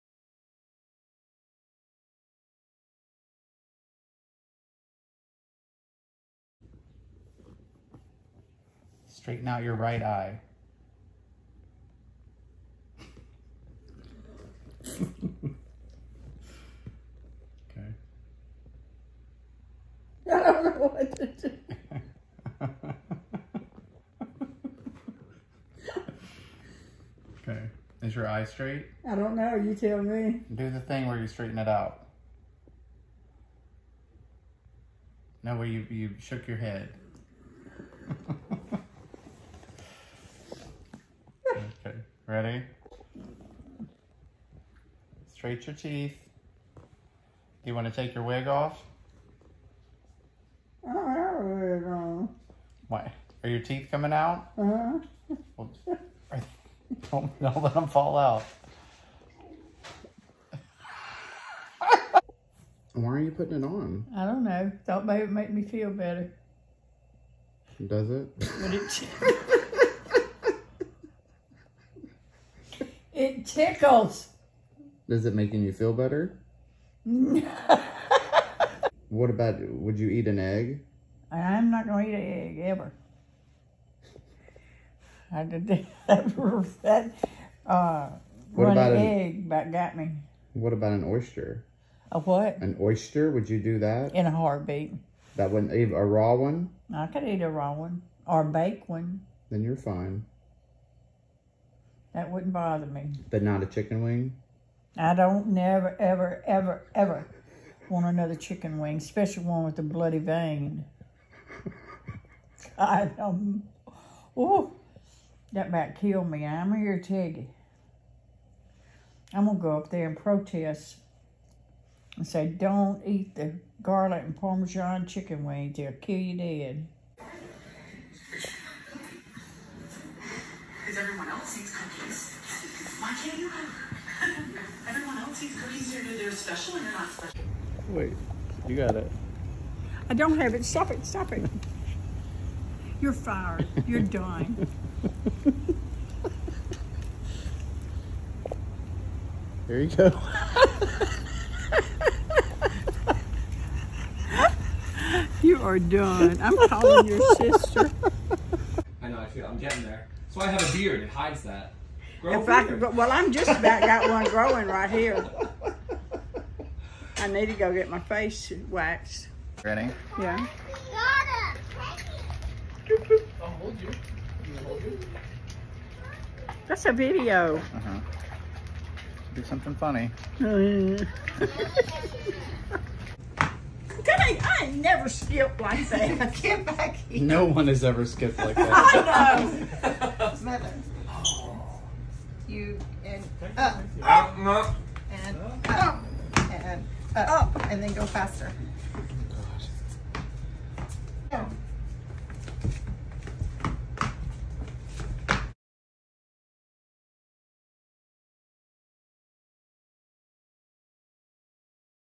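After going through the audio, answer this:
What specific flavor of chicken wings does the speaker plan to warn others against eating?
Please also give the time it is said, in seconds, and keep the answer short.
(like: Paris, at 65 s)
garlic and Parmesan, at 123 s.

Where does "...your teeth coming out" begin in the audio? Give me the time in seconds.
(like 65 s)
53 s.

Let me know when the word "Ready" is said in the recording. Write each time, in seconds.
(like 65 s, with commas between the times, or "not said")
42 s, 169 s.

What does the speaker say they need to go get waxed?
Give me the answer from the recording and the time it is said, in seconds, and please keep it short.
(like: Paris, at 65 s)
face, at 167 s.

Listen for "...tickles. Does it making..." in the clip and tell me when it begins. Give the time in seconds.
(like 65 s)
73 s.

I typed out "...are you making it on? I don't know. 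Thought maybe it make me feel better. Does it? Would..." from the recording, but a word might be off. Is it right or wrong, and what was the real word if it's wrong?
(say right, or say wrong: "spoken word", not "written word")
wrong: "putting", not "making".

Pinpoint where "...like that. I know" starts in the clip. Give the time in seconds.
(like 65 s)
188 s.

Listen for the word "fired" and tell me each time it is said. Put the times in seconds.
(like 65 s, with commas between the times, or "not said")
143 s.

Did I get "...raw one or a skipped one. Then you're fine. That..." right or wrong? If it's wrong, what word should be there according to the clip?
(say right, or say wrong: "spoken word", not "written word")
wrong: "baked", not "skipped".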